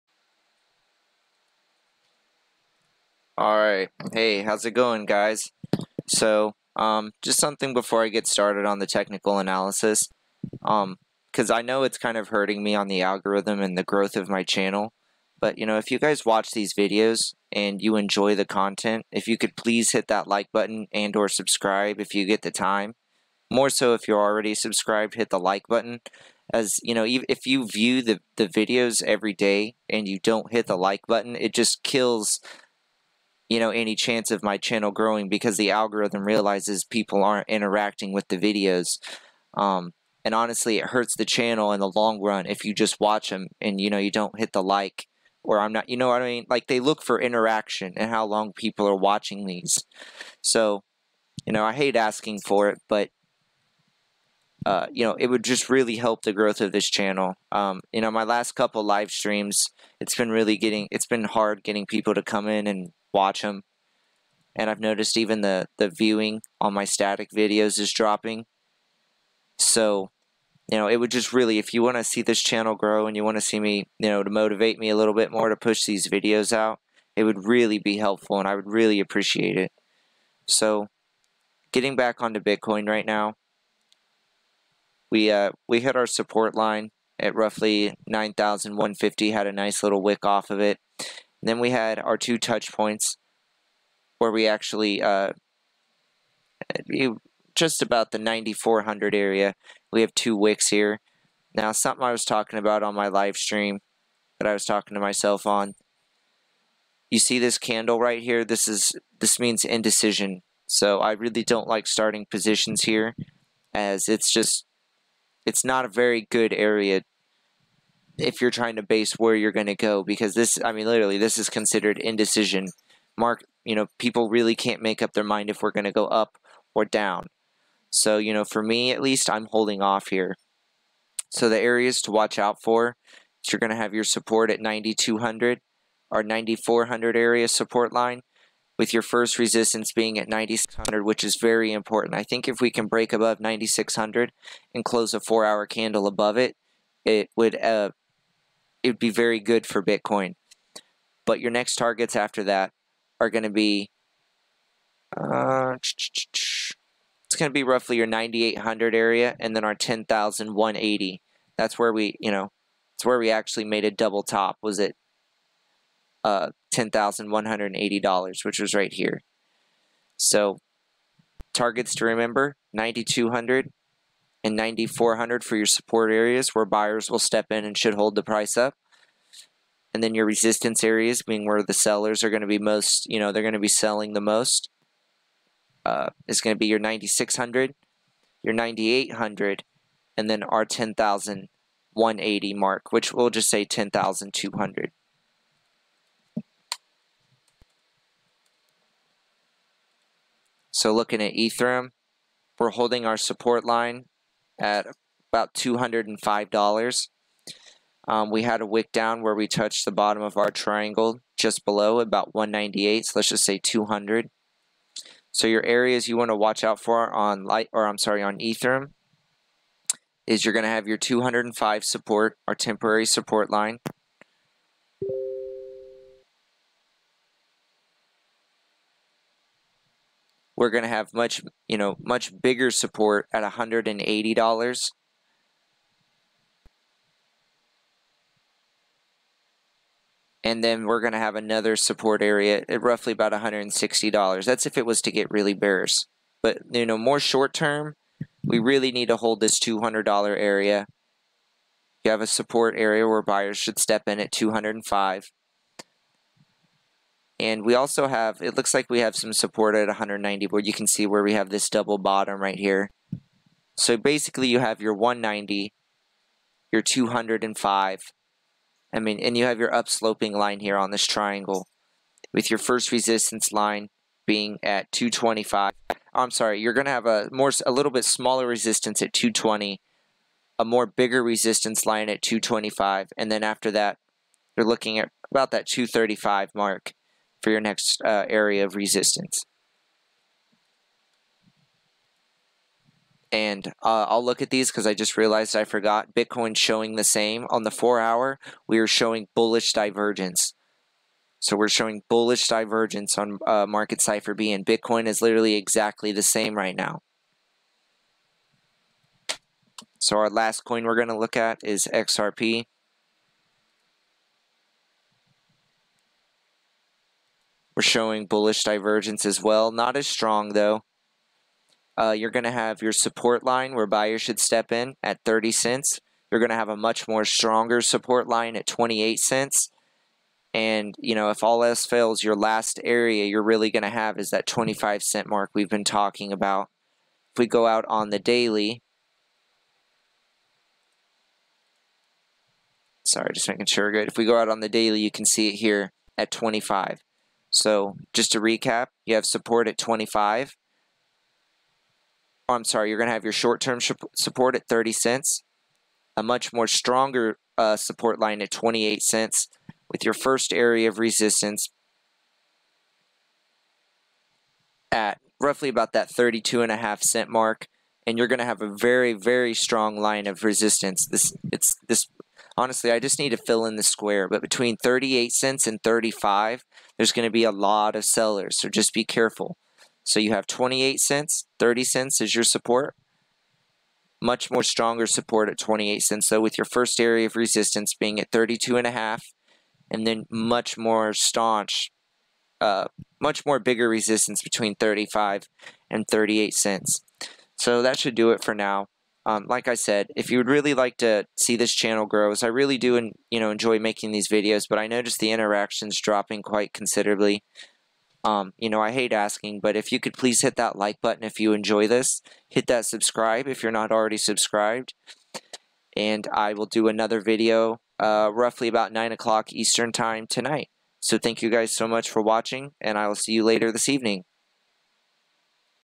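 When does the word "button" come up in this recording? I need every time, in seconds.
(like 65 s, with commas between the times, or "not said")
20 s, 25 s, 31 s, 411 s.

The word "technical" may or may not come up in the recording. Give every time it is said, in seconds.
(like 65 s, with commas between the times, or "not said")
8 s.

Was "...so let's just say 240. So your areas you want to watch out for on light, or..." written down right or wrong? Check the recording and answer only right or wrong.
wrong.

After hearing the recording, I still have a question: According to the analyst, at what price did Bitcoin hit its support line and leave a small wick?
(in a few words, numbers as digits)
9,150.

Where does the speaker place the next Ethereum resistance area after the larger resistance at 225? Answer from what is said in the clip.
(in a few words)
235.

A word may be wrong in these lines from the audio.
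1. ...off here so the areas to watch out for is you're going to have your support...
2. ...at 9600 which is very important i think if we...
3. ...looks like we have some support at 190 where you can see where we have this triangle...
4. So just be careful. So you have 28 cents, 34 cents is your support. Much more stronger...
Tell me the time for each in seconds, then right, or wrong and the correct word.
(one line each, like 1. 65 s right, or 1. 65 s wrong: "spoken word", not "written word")
1. 129 s right
2. 140 s right
3. 258 s wrong: "double", not "triangle"
4. 378 s wrong: "30", not "34".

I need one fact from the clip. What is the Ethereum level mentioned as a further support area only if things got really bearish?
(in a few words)
$160.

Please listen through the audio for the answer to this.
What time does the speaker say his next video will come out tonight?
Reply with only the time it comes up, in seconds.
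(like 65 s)
418 s.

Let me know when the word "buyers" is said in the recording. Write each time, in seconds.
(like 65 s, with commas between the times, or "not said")
176 s, 253 s, 323 s.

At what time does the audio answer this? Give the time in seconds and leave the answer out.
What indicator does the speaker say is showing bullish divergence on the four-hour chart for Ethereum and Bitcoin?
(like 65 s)
303 s.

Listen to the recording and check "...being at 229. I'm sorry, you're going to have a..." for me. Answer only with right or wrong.
wrong.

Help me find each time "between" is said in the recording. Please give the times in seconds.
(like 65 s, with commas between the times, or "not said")
374 s, 394 s.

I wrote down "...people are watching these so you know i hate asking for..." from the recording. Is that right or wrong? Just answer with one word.
right.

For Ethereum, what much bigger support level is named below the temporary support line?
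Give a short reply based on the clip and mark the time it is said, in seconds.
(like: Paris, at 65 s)
$180, at 233 s.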